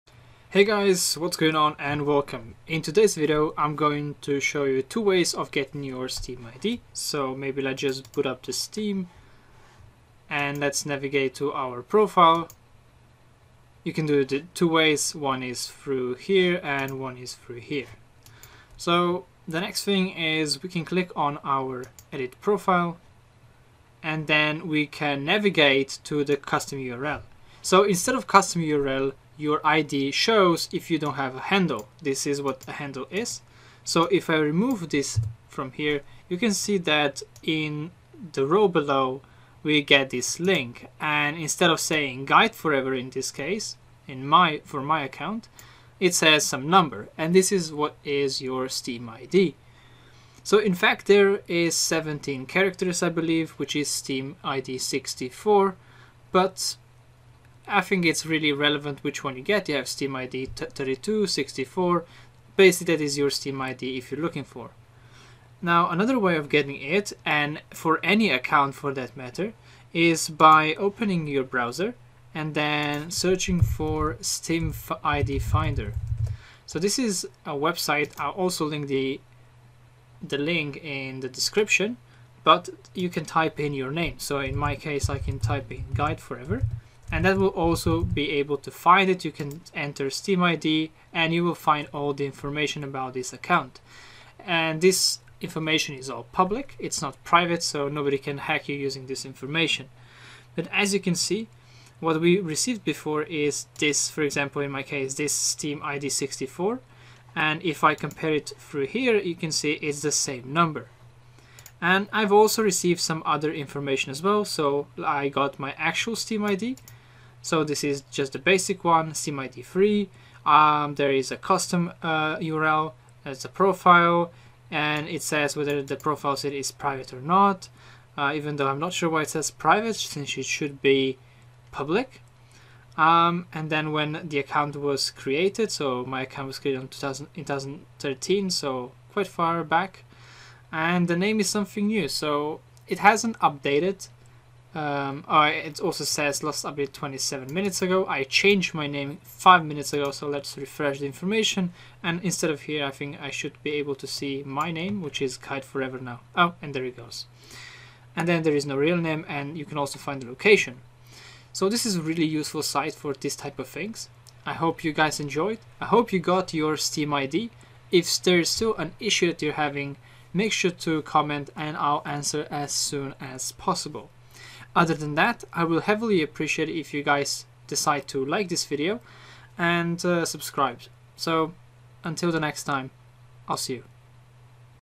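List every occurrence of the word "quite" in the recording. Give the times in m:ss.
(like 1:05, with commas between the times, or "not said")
2:19.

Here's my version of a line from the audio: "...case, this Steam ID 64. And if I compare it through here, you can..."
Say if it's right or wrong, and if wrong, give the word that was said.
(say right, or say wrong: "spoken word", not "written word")
right.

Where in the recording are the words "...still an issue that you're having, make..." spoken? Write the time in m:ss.
2:48.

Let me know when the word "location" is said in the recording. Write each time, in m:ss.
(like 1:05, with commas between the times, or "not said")
2:40.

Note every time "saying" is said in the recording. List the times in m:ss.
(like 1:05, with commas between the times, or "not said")
0:41.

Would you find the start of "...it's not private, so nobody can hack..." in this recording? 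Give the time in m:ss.
1:36.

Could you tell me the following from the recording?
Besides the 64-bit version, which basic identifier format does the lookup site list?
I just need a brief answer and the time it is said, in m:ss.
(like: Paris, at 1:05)
SteamID3, at 1:59.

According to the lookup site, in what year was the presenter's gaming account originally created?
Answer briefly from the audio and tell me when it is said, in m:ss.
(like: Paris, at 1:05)
2013, at 2:17.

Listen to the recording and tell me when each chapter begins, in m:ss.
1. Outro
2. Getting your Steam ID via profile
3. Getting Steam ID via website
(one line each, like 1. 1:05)
1. 2:45
2. 0:10
3. 1:10.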